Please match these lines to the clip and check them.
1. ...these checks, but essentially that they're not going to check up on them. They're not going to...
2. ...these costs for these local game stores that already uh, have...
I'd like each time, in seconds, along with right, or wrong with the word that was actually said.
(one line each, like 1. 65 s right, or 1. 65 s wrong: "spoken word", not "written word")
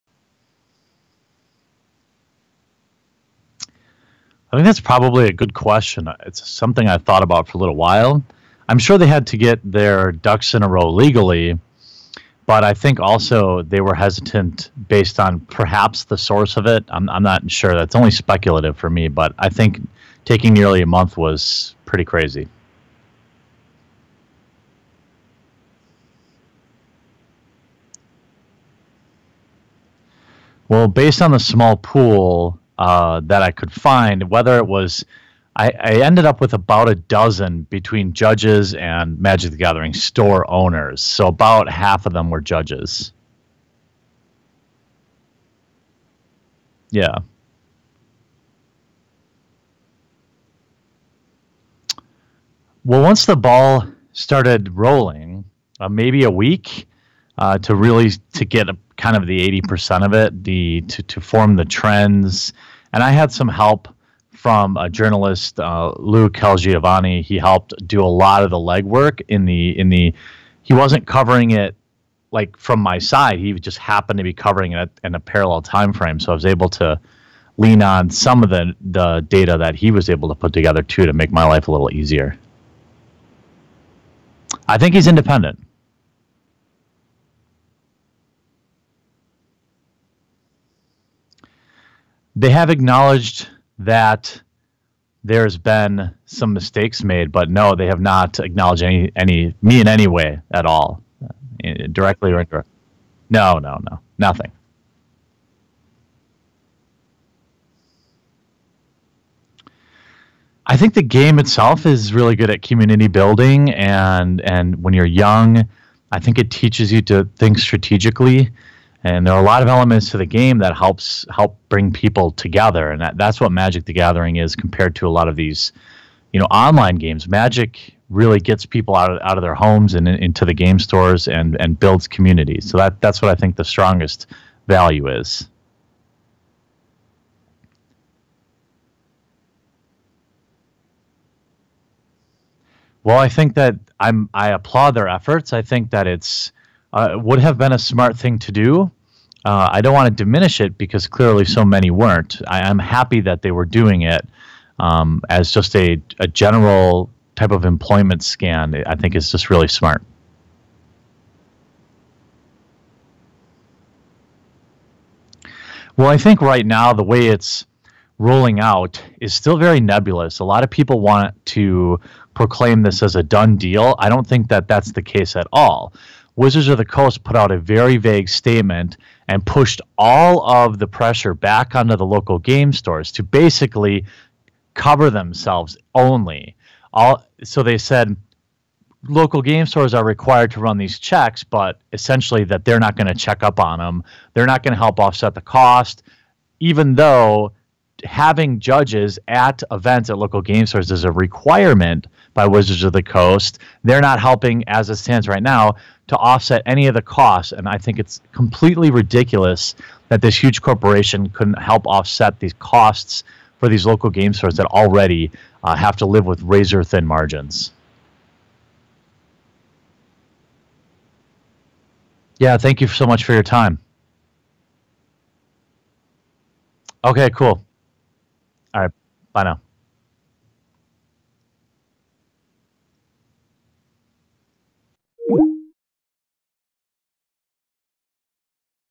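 1. 190 s right
2. 212 s right.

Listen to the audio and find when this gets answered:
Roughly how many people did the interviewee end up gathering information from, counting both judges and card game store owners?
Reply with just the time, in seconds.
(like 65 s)
36 s.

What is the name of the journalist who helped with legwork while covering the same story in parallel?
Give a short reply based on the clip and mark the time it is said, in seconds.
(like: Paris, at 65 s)
Lou Calgiovanni, at 65 s.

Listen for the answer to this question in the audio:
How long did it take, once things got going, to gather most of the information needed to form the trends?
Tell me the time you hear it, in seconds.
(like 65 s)
56 s.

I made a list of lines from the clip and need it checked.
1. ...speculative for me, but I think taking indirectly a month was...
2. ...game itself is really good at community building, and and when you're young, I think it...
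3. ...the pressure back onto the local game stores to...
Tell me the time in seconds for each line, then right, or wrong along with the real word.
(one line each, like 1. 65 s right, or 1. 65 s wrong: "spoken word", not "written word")
1. 18 s wrong: "nearly", not "indirectly"
2. 111 s right
3. 180 s right.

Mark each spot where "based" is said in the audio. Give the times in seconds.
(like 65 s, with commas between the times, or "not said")
14 s, 30 s.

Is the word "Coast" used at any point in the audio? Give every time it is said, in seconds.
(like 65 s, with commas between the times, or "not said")
176 s, 203 s.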